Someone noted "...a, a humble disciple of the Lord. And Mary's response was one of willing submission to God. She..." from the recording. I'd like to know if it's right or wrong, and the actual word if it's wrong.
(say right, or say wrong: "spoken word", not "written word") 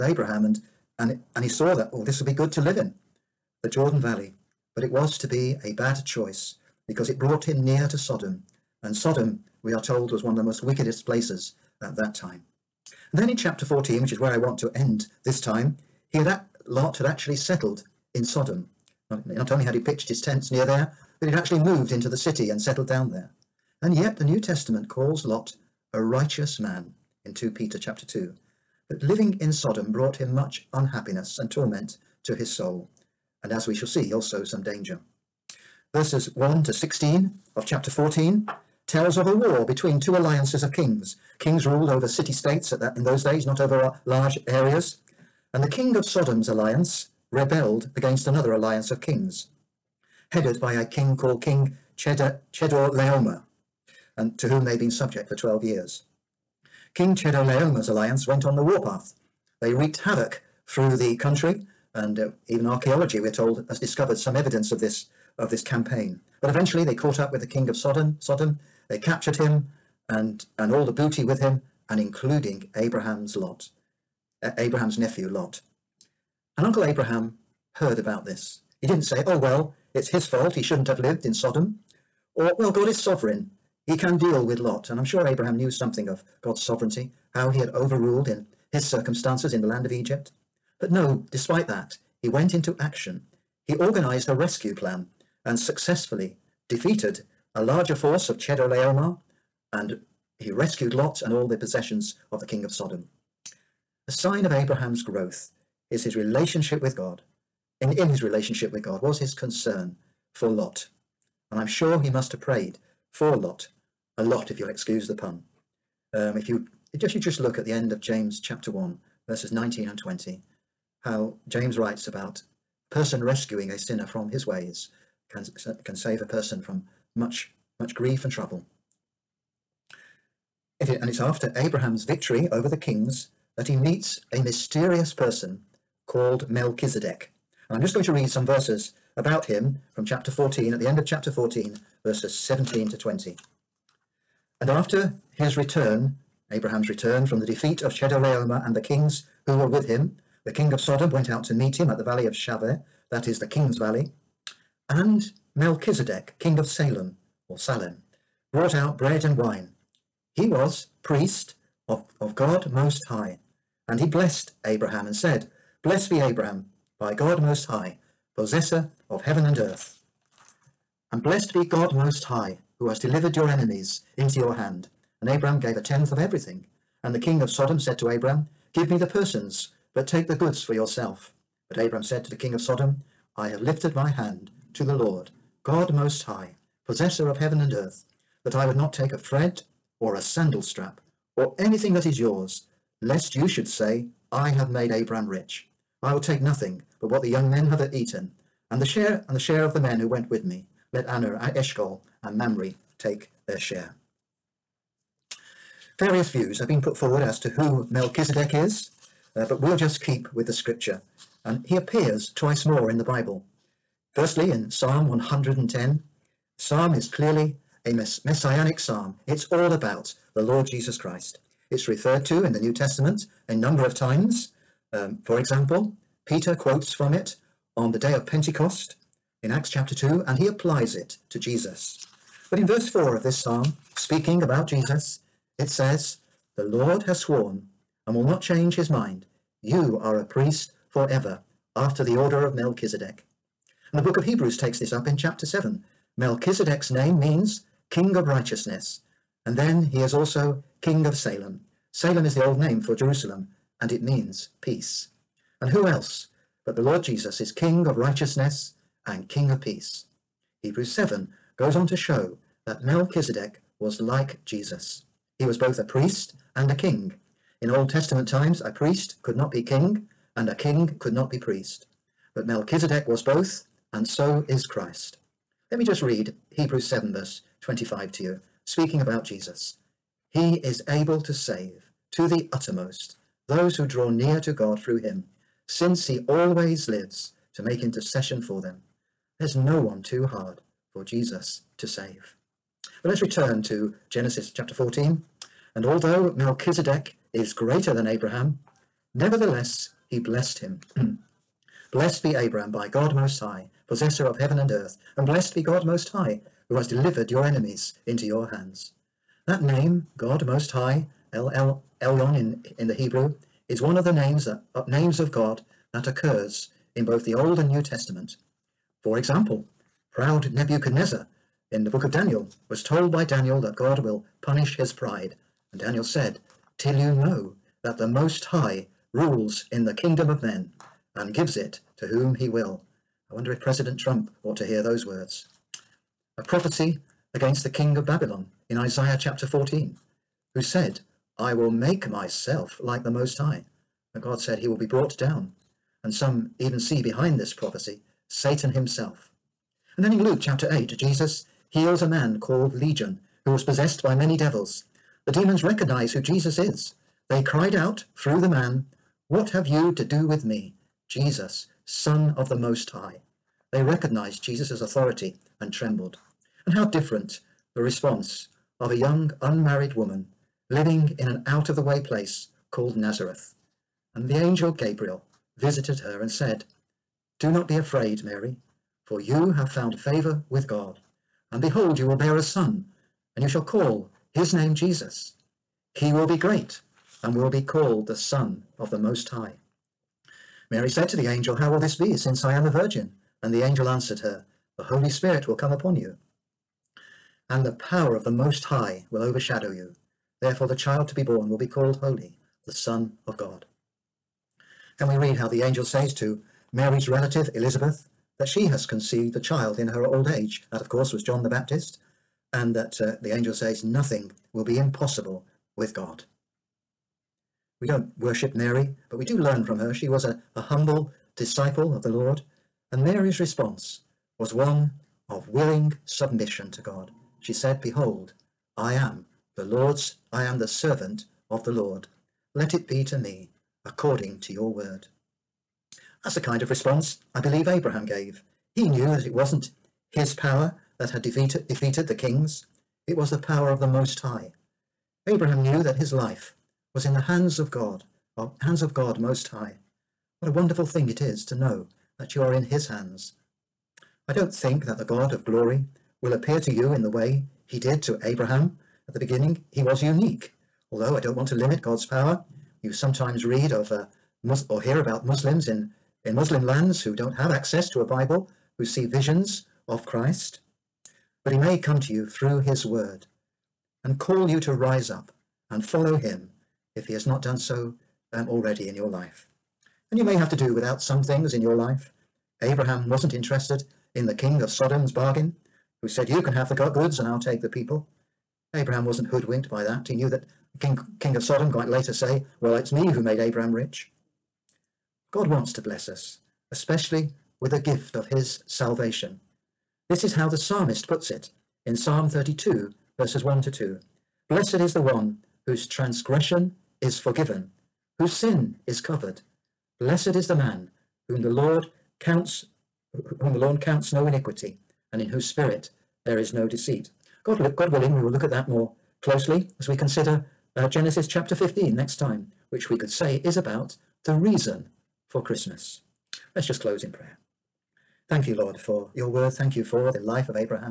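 right.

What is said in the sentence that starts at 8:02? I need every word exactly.
Abraham wasn't interested in the king of Sodom's bargain, who said, You can have the goods and I'll take the people.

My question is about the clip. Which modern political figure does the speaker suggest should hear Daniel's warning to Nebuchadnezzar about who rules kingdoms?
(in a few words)
President Trump.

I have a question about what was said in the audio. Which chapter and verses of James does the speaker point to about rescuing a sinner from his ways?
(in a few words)
James 1:19-20.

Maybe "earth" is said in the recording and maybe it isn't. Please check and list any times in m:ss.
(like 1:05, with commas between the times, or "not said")
2:49, 3:07, 5:04.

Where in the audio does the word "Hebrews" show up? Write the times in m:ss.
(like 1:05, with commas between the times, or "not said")
4:04, 4:20, 4:36, 5:12.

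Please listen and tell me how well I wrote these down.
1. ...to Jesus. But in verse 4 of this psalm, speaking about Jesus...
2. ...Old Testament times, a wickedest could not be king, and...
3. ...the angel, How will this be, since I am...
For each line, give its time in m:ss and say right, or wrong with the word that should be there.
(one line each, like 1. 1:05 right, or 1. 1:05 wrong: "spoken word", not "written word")
1. 3:51 right
2. 4:27 wrong: "priest", not "wickedest"
3. 6:31 right.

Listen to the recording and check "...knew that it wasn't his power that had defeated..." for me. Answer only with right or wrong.
right.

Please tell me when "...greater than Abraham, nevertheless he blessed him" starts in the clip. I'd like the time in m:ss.
4:57.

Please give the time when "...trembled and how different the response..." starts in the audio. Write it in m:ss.
6:05.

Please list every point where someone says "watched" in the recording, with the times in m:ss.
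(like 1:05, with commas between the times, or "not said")
not said.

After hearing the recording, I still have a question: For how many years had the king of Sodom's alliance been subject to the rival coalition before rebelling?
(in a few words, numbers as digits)
12.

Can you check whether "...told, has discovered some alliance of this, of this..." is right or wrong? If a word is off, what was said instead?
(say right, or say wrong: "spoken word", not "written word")
wrong: "evidence", not "alliance".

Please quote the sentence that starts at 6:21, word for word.
And behold, you will bear a son, and you shall call his name Jesus.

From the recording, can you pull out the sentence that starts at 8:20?
This is how the psalmist puts it in Psalm 32, verses 1 to 2.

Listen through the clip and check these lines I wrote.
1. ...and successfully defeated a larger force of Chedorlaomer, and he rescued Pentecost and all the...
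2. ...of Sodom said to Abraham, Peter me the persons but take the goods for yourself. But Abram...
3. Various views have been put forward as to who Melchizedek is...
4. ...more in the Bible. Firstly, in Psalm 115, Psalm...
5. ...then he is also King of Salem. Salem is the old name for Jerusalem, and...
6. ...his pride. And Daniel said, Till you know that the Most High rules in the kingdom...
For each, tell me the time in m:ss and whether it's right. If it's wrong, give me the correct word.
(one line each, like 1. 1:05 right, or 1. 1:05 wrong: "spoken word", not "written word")
1. 1:35 wrong: "Lot", not "Pentecost"
2. 2:57 wrong: "Give", not "Peter"
3. 3:25 right
4. 3:32 wrong: "110", not "115"
5. 4:09 right
6. 5:24 right.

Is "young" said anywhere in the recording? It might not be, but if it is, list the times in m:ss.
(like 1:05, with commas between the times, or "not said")
3:17, 6:08.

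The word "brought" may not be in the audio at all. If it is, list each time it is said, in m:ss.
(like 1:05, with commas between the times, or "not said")
0:07, 0:29, 2:38, 5:44.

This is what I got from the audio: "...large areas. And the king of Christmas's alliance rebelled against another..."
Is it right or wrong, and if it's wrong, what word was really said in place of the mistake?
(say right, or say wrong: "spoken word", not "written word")
wrong: "Sodom", not "Christmas".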